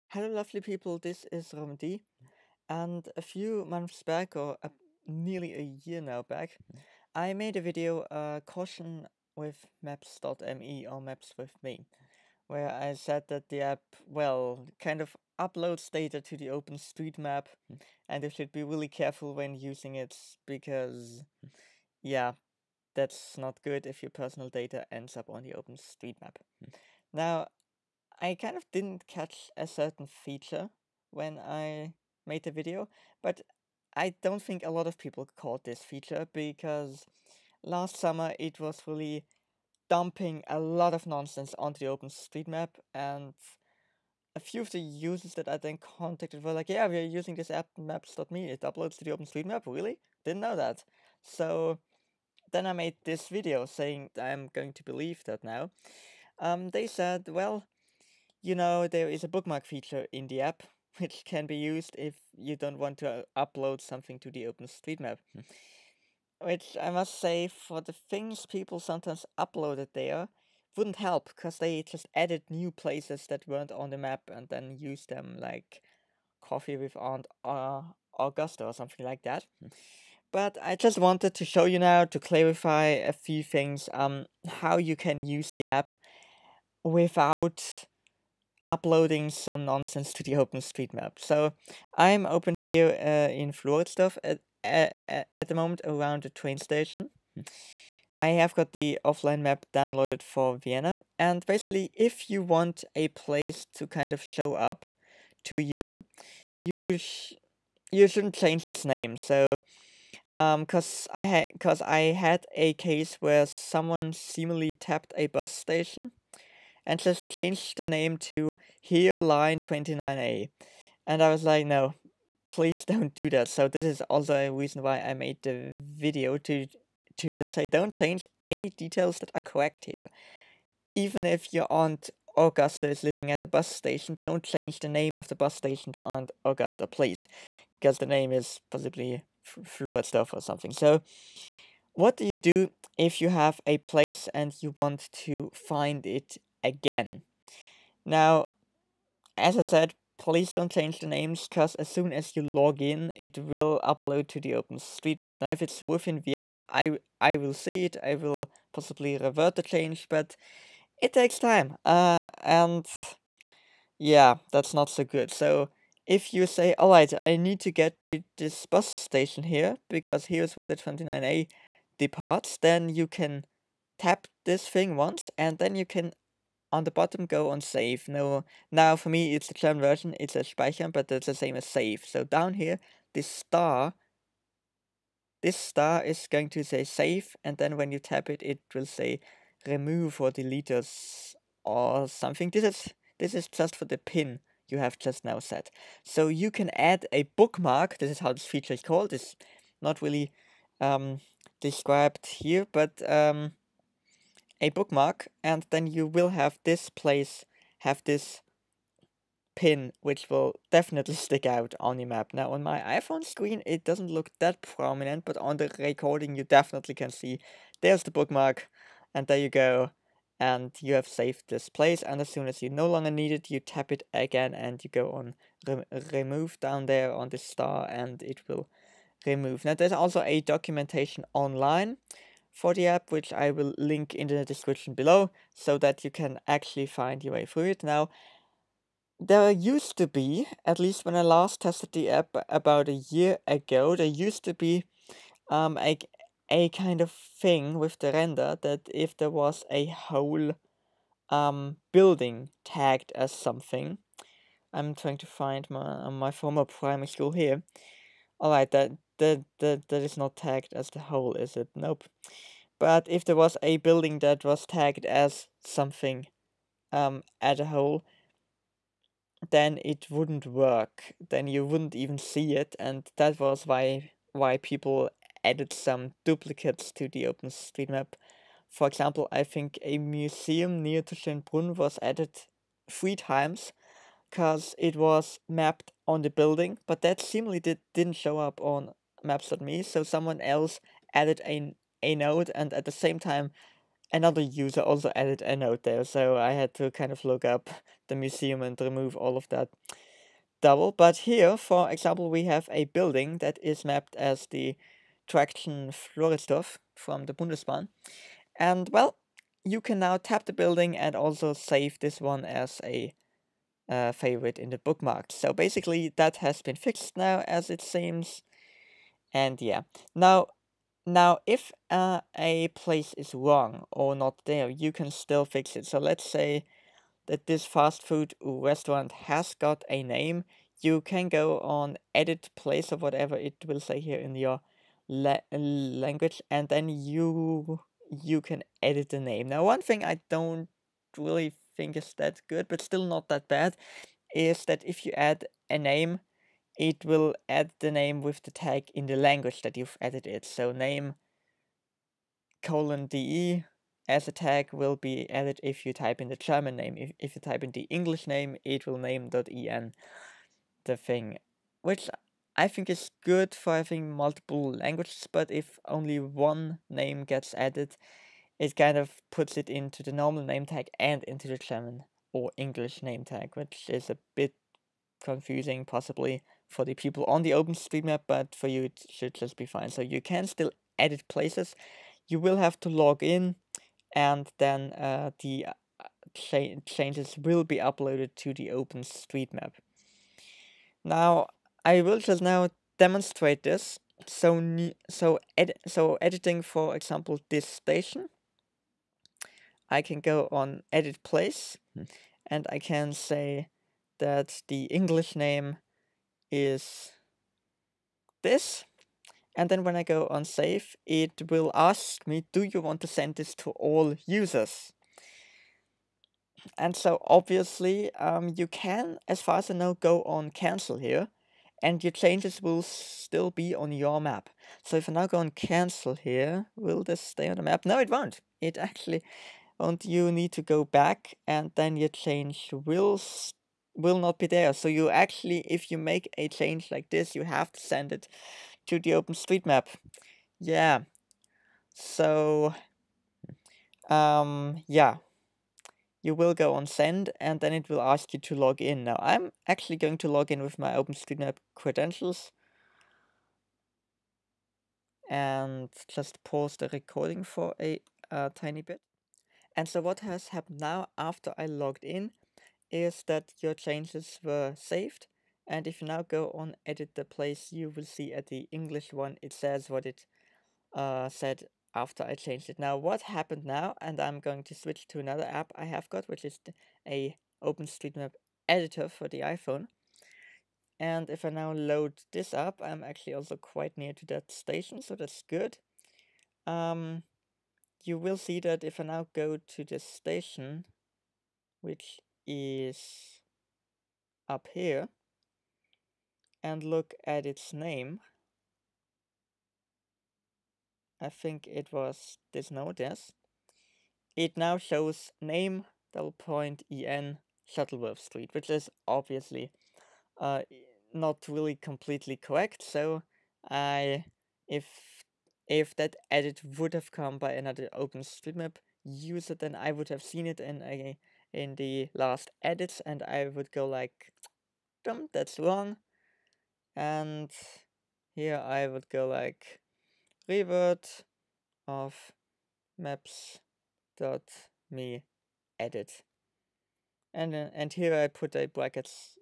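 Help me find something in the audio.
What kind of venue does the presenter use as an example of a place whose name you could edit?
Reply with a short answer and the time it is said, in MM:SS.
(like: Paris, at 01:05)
fast food restaurant, at 05:27.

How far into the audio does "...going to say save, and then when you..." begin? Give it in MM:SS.
03:06.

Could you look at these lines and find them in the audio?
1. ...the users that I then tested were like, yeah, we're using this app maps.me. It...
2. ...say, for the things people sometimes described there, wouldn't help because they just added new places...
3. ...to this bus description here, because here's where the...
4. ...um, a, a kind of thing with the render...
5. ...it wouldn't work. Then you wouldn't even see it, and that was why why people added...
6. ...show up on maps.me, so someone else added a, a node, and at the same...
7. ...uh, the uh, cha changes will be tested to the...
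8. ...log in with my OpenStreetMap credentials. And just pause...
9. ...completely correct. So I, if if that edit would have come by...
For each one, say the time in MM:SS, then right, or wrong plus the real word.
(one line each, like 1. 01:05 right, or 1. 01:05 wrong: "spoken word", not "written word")
1. 00:44 wrong: "contacted", not "tested"
2. 01:07 wrong: "uploaded", not "described"
3. 02:48 wrong: "station", not "description"
4. 04:05 right
5. 04:29 right
6. 04:48 right
7. 06:24 wrong: "uploaded", not "tested"
8. 07:30 right
9. 08:31 right.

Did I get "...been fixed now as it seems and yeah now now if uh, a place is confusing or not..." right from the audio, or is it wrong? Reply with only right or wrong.
wrong.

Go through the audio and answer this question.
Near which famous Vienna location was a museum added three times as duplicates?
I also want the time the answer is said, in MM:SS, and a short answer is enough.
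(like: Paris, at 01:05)
Schönbrunn, at 04:41.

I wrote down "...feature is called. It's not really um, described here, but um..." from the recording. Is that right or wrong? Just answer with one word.
right.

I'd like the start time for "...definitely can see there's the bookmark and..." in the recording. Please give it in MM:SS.
03:36.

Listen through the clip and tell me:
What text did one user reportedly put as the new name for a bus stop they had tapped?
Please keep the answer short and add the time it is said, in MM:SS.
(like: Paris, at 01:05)
Here Line 29A, at 01:58.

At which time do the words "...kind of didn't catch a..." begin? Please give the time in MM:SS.
00:28.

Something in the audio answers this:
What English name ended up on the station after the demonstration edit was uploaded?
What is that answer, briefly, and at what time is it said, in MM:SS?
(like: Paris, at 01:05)
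Shuttleworth Street, at 08:27.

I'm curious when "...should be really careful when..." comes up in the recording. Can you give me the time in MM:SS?
00:18.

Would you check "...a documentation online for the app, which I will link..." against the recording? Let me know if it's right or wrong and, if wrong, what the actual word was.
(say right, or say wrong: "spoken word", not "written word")
right.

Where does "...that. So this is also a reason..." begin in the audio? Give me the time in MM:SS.
02:03.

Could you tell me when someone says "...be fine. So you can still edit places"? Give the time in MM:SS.
06:19.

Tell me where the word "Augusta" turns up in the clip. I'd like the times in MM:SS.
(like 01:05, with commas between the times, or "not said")
01:18, 02:12, 02:16.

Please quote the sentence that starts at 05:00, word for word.
But here, for example, we have a building that is mapped as the Traction Floridsdorf from the Bundesbahn.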